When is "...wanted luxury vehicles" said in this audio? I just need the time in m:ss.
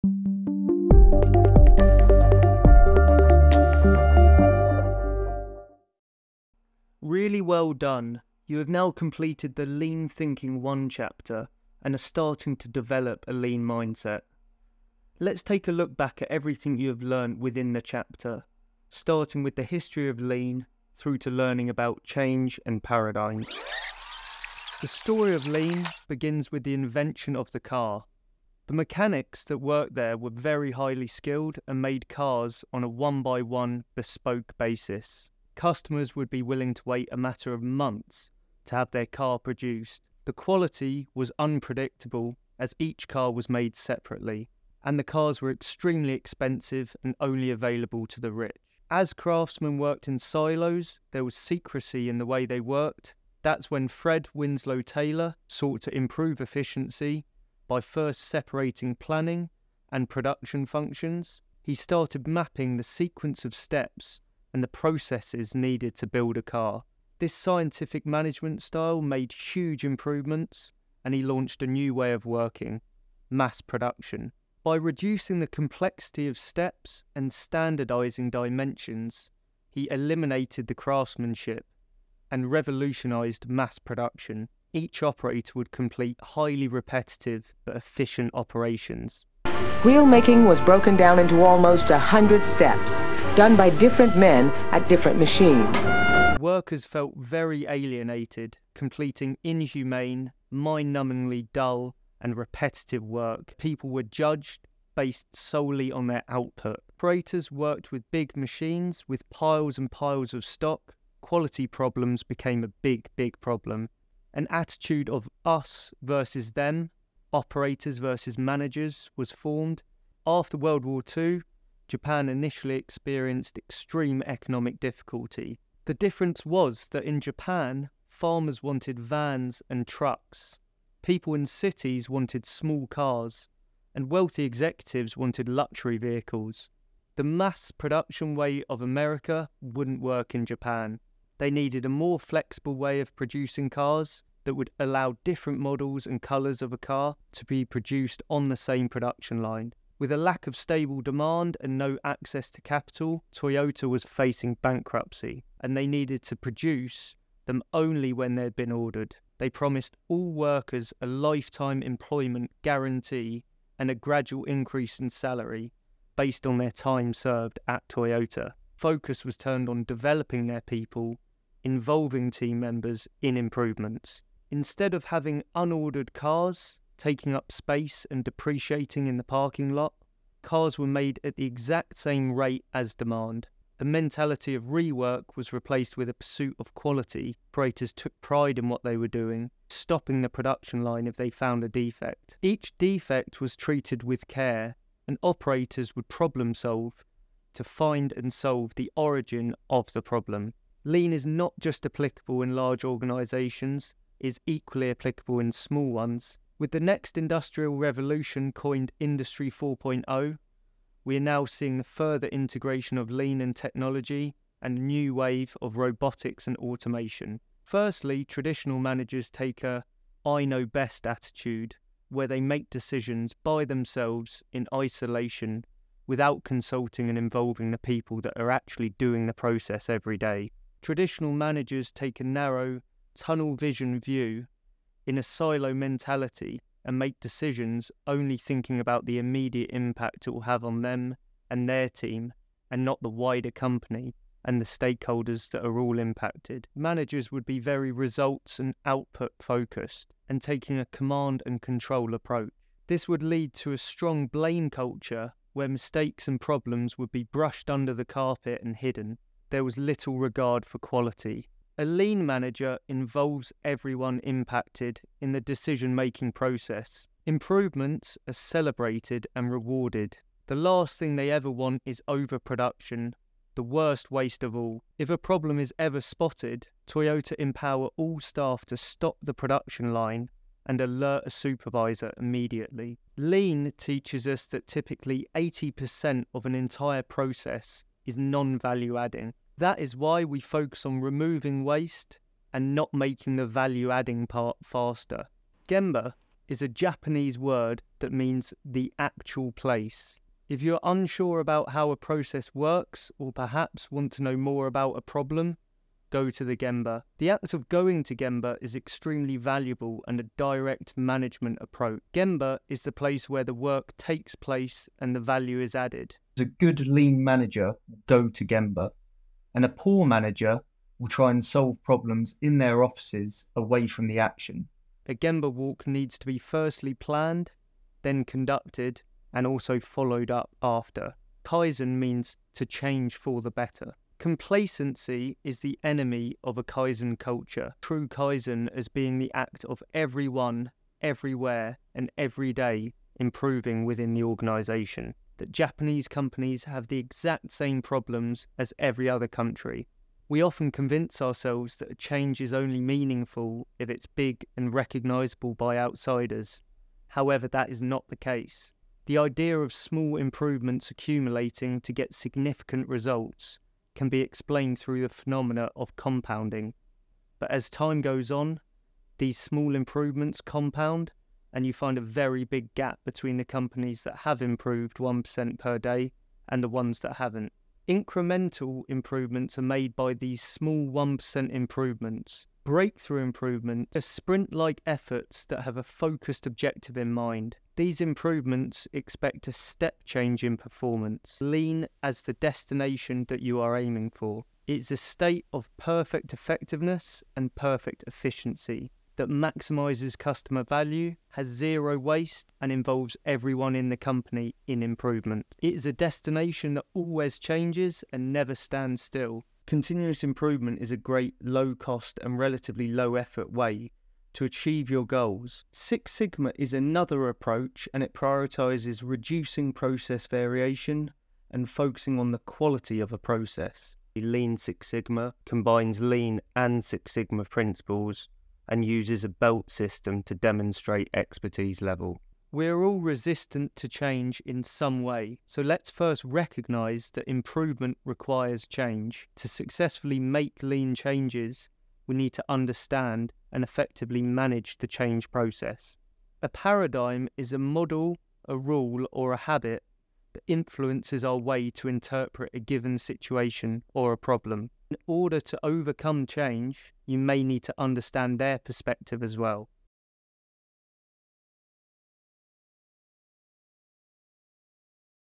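2:15.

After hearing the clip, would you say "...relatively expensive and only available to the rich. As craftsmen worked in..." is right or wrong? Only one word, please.
wrong.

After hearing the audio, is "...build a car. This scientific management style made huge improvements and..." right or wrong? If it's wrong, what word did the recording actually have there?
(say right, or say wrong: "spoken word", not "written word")
right.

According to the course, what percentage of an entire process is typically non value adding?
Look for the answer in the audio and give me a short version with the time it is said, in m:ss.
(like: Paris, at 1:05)
80%, at 4:45.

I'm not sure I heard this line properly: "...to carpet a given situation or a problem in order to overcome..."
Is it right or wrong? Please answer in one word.
wrong.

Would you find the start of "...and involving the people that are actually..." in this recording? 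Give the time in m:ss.
3:47.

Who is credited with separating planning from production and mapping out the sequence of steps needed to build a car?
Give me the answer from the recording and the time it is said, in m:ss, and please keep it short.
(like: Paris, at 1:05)
Fred Winslow Taylor, at 0:53.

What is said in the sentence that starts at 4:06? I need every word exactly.
Managers would be very results and output focused and taking a command and control approach.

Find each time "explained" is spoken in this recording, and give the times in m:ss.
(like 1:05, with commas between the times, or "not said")
6:04.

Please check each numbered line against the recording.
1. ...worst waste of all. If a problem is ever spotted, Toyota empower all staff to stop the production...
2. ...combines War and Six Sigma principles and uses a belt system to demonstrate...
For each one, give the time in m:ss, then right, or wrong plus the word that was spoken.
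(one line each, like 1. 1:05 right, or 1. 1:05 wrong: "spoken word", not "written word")
1. 4:33 right
2. 7:05 wrong: "Lean", not "War".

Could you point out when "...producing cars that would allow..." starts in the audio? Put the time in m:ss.
2:23.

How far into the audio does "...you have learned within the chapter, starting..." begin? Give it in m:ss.
0:16.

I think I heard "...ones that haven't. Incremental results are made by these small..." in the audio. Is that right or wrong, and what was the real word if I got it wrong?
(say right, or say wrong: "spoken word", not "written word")
wrong: "improvements", not "results".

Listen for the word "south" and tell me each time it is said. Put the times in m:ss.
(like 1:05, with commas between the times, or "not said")
not said.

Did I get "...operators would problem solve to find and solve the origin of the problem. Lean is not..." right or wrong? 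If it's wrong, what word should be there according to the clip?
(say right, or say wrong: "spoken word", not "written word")
right.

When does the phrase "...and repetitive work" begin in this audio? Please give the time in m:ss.
1:42.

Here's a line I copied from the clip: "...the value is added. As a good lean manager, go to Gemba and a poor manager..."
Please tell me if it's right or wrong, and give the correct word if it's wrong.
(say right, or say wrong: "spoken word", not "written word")
right.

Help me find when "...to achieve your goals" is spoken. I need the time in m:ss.
6:54.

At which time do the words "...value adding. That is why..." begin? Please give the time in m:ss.
4:48.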